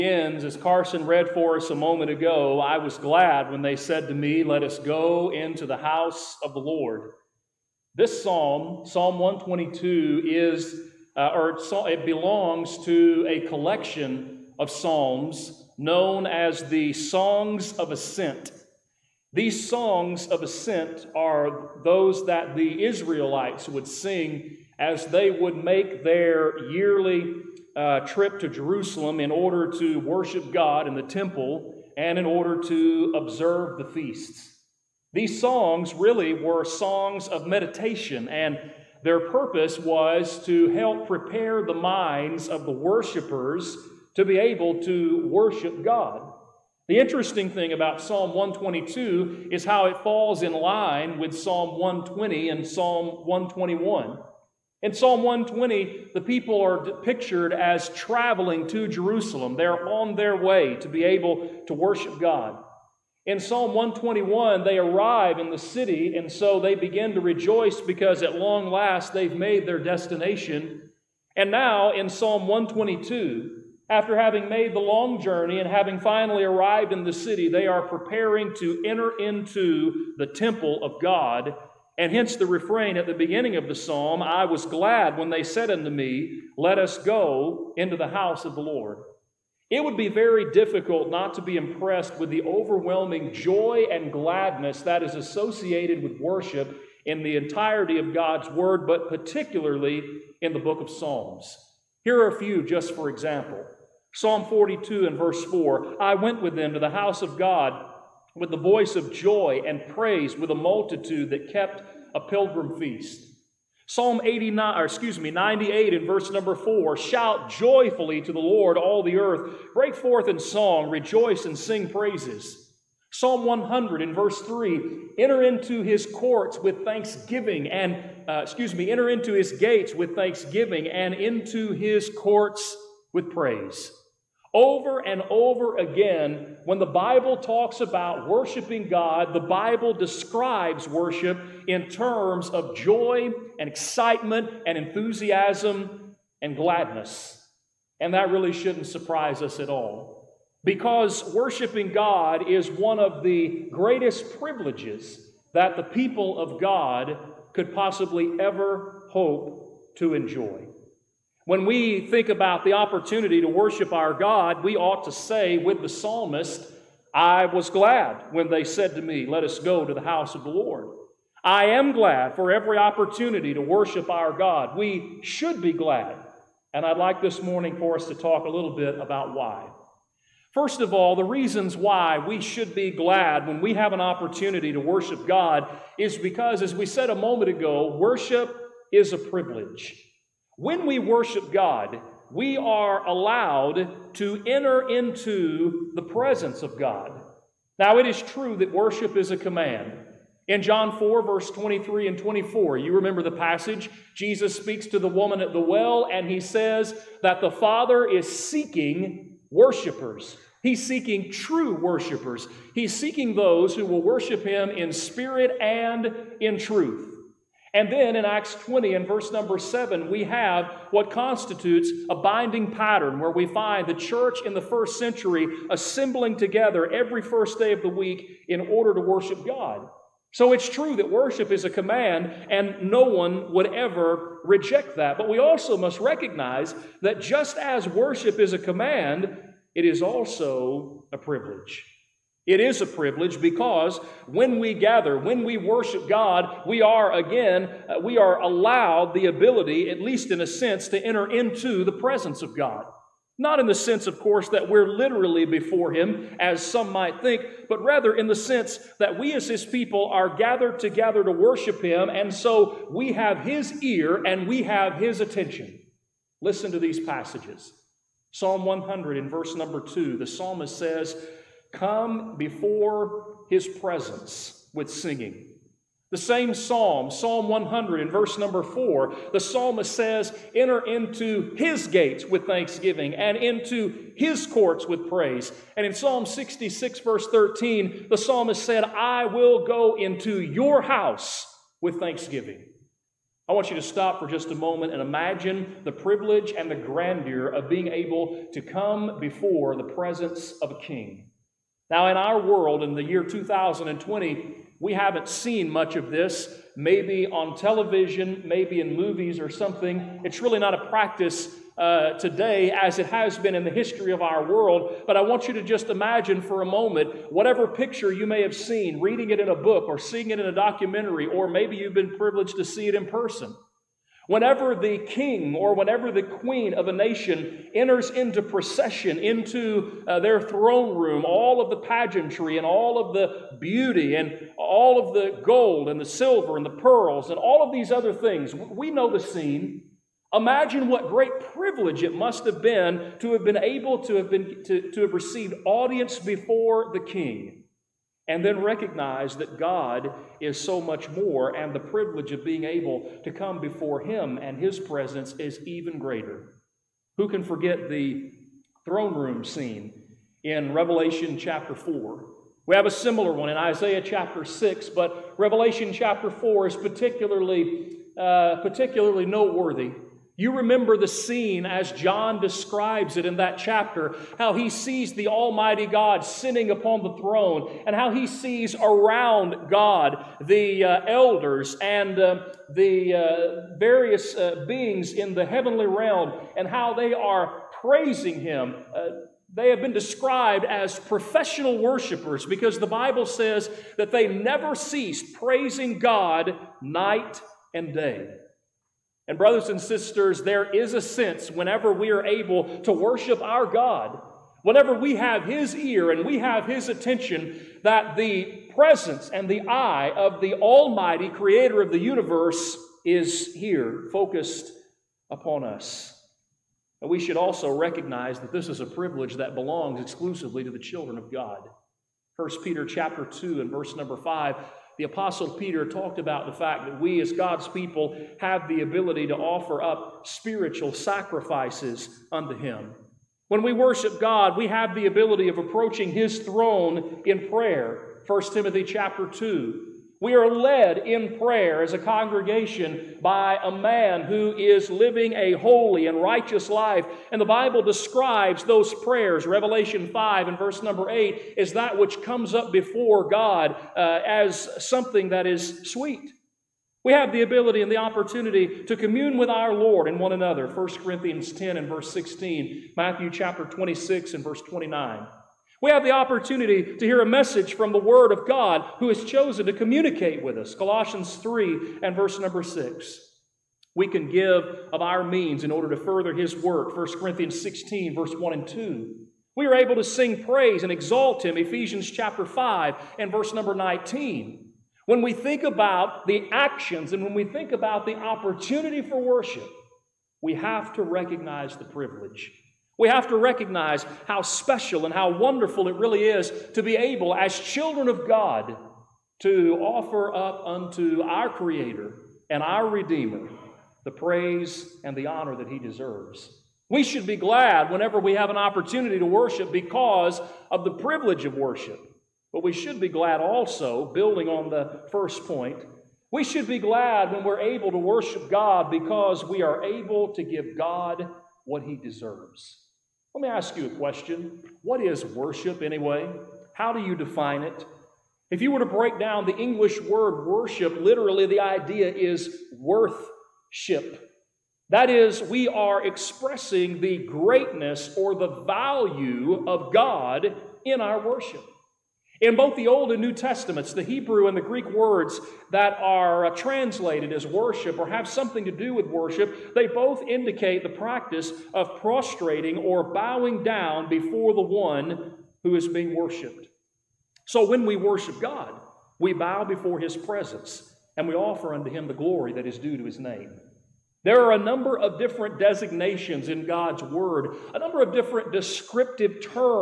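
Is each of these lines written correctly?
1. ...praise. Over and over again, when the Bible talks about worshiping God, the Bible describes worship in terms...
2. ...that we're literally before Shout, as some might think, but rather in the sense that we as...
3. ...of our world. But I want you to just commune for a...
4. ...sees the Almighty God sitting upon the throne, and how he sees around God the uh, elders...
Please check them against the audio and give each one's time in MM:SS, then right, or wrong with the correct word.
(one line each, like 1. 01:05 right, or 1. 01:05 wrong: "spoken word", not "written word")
1. 02:13 right
2. 04:14 wrong: "Him", not "Shout"
3. 05:14 wrong: "imagine", not "commune"
4. 06:14 right.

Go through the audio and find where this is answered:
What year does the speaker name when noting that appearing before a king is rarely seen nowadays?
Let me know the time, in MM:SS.
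05:03.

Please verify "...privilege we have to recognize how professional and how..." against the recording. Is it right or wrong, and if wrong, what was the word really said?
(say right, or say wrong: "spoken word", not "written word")
wrong: "special", not "professional".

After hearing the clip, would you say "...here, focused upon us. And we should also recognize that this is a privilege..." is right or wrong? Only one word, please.
right.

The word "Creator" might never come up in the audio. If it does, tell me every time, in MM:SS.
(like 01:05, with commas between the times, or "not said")
06:51, 08:21.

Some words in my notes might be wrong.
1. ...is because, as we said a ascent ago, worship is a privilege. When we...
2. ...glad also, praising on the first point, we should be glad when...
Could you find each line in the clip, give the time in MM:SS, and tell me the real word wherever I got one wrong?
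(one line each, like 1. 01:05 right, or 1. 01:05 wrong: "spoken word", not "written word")
1. 03:05 wrong: "moment", not "ascent"
2. 08:33 wrong: "building", not "praising".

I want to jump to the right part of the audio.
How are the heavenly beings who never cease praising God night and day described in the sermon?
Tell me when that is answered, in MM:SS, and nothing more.
06:30.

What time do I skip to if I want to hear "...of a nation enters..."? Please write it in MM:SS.
05:26.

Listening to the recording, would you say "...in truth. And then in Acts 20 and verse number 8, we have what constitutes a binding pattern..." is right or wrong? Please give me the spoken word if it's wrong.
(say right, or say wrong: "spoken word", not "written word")
wrong: "7", not "8".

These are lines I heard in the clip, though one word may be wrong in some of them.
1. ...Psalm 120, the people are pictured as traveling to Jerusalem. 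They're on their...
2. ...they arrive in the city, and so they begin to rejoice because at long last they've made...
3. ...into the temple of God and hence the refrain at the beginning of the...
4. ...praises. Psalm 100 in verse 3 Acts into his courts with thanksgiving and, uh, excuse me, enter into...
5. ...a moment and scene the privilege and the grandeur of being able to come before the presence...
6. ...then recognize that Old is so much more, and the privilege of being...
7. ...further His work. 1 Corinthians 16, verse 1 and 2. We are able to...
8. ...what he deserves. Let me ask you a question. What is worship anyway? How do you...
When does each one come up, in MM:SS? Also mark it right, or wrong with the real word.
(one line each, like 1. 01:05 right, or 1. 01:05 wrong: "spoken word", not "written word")
1. 00:54 right
2. 01:04 right
3. 01:19 right
4. 02:01 wrong: "Enter", not "Acts"
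5. 04:54 wrong: "imagine", not "scene"
6. 05:48 wrong: "God", not "Old"
7. 07:56 right
8. 08:41 right.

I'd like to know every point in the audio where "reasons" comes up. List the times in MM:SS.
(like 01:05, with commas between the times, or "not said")
03:01.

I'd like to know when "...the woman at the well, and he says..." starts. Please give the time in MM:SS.
03:24.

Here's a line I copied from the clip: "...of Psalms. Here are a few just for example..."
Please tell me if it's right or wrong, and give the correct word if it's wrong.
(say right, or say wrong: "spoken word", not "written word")
right.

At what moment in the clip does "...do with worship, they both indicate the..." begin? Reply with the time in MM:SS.
09:08.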